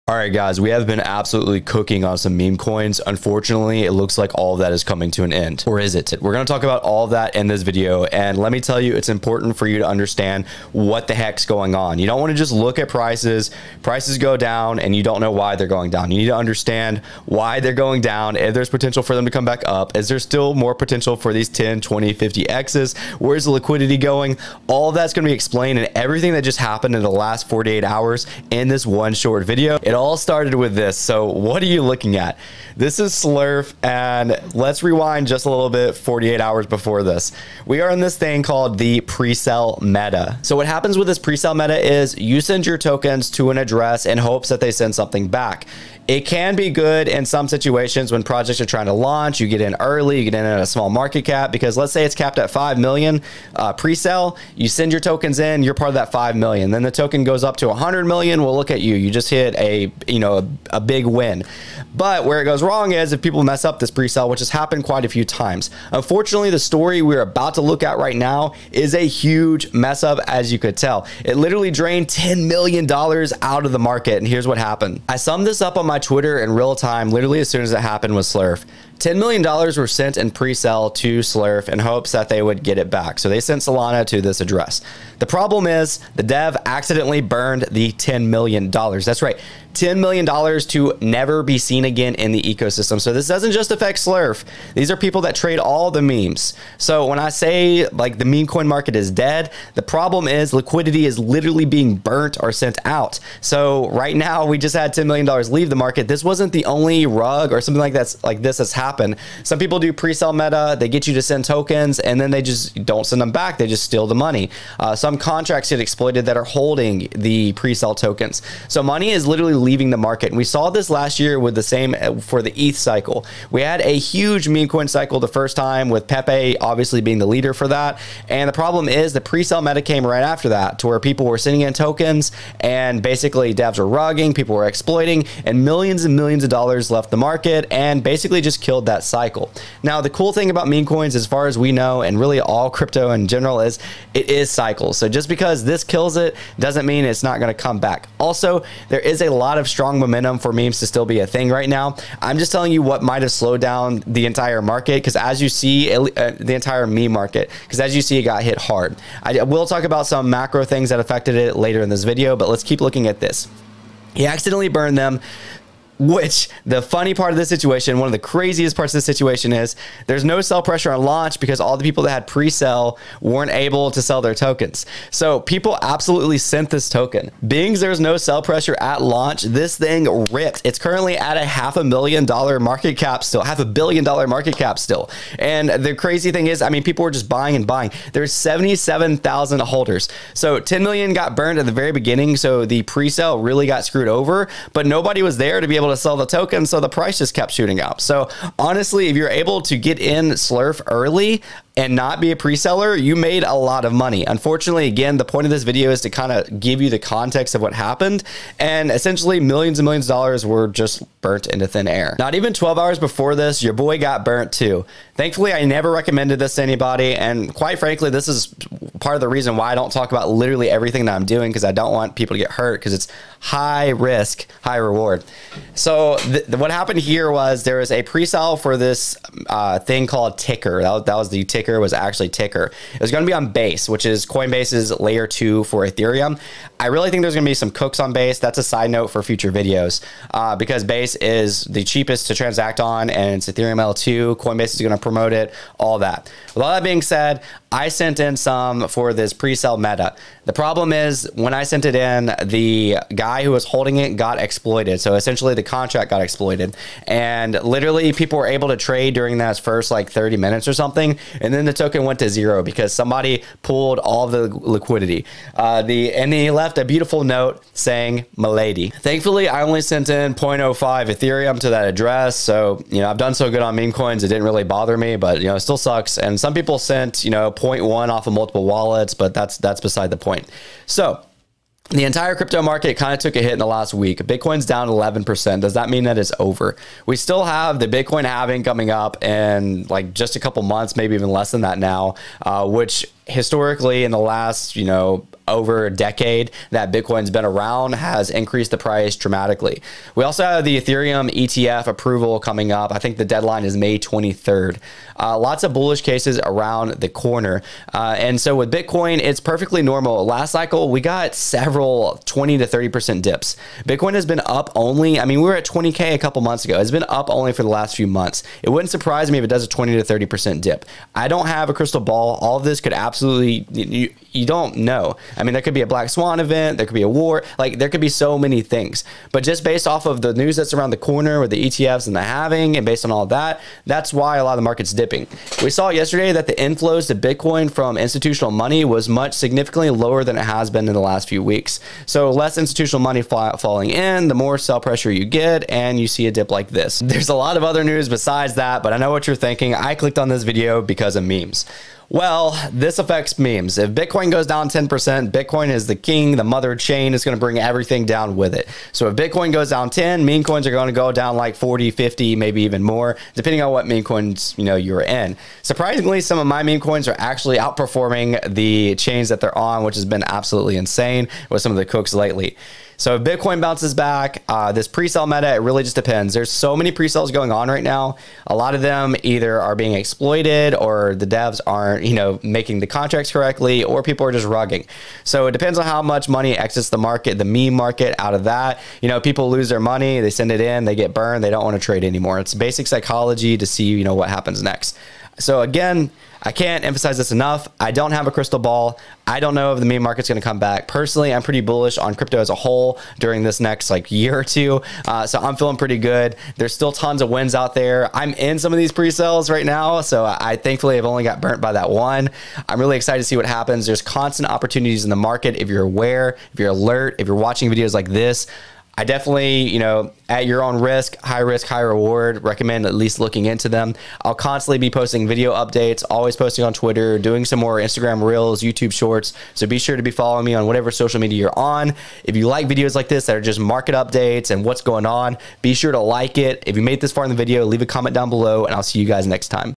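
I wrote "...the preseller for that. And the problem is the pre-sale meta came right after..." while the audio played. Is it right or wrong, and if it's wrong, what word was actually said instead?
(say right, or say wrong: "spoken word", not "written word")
wrong: "leader", not "preseller".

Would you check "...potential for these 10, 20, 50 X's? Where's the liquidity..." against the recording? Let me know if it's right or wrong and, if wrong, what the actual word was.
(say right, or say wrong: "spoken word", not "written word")
right.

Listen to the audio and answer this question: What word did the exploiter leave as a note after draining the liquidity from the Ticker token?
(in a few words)
Milady.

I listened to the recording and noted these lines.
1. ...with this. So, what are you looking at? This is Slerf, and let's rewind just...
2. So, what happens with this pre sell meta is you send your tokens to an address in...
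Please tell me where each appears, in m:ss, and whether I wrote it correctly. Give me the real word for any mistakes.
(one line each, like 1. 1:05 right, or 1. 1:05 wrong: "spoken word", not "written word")
1. 0:30 right
2. 0:40 right.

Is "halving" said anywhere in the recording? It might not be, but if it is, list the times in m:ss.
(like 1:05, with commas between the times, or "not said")
4:48, 5:32.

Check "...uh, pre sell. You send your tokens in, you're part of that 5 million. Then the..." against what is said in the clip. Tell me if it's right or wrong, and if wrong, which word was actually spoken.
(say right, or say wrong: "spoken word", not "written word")
right.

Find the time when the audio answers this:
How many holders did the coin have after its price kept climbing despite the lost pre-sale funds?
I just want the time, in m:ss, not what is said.
3:08.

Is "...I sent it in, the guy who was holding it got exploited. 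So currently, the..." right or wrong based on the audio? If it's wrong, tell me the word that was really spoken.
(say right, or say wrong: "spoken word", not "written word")
wrong: "essentially", not "currently".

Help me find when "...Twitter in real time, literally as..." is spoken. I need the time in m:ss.
1:15.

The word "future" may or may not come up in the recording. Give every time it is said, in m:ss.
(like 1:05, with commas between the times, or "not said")
3:59.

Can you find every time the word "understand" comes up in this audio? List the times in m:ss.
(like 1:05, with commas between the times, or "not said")
0:09, 0:16.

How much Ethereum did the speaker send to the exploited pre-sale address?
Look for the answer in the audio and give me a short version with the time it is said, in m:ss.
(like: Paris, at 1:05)
0.05 Ethereum, at 4:30.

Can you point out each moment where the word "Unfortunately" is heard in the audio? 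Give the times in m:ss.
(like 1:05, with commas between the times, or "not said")
0:03, 1:05, 3:24.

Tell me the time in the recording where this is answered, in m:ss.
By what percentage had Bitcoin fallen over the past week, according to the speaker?
4:44.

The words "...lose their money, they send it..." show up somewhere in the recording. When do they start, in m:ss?
6:29.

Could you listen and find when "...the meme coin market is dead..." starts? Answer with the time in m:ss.
1:38.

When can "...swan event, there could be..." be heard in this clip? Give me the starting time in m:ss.
5:26.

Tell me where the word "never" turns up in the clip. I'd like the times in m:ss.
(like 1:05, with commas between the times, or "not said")
1:31, 3:35.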